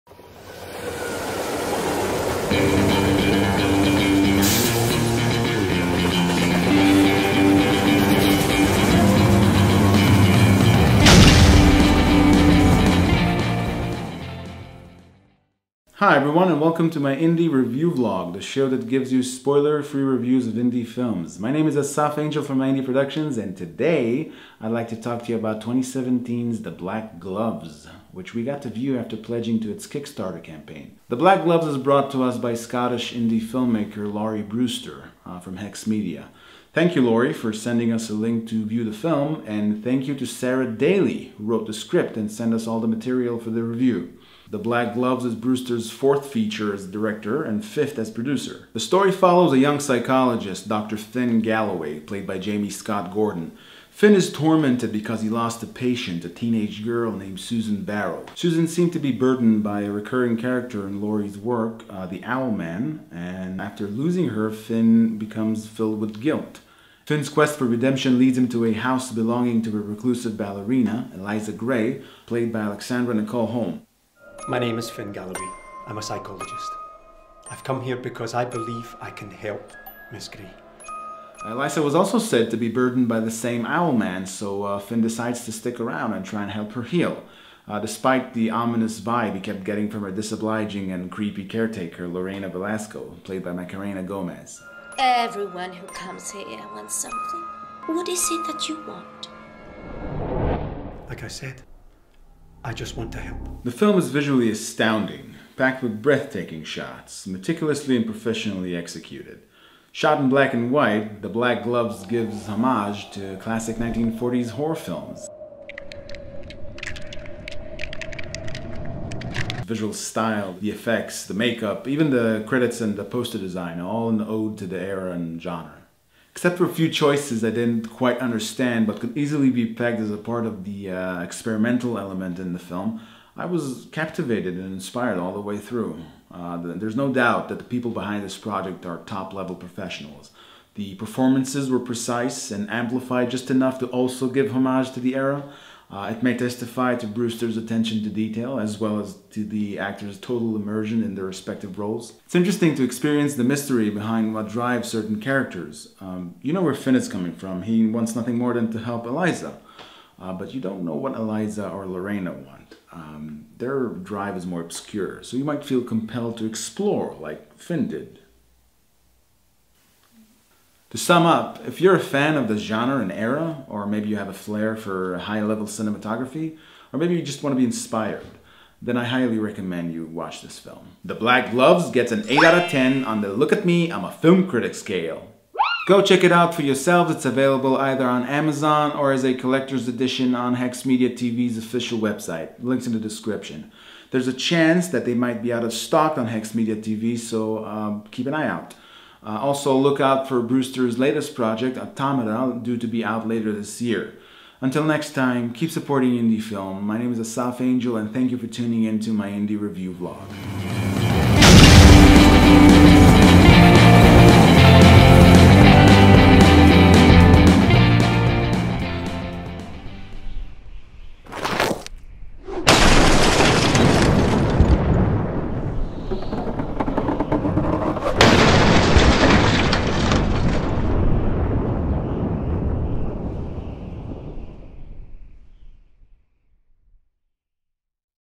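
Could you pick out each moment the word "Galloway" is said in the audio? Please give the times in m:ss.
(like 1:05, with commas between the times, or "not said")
0:51, 1:15.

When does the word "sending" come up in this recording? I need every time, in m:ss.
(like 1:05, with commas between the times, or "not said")
0:37.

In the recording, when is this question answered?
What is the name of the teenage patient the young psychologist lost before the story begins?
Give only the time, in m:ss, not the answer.
0:57.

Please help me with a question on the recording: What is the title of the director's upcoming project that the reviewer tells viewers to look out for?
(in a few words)
Automata.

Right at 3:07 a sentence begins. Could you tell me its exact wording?
It's available either on Amazon or as a collector's edition on Hex Media TV's official website.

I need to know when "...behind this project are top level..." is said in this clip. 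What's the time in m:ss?
2:17.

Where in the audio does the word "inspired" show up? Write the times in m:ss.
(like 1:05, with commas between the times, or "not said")
2:14, 2:57.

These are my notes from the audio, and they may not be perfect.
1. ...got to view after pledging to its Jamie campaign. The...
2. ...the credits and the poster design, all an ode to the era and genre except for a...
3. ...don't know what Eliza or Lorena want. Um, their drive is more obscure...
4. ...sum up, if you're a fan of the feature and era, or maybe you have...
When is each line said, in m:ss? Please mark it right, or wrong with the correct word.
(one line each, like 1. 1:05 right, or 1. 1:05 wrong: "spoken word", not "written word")
1. 0:28 wrong: "Kickstarter", not "Jamie"
2. 2:02 right
3. 2:40 right
4. 2:50 wrong: "genre", not "feature".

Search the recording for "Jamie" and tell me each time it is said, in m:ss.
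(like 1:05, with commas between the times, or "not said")
0:52.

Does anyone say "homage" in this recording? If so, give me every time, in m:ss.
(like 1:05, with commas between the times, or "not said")
1:52, 2:24.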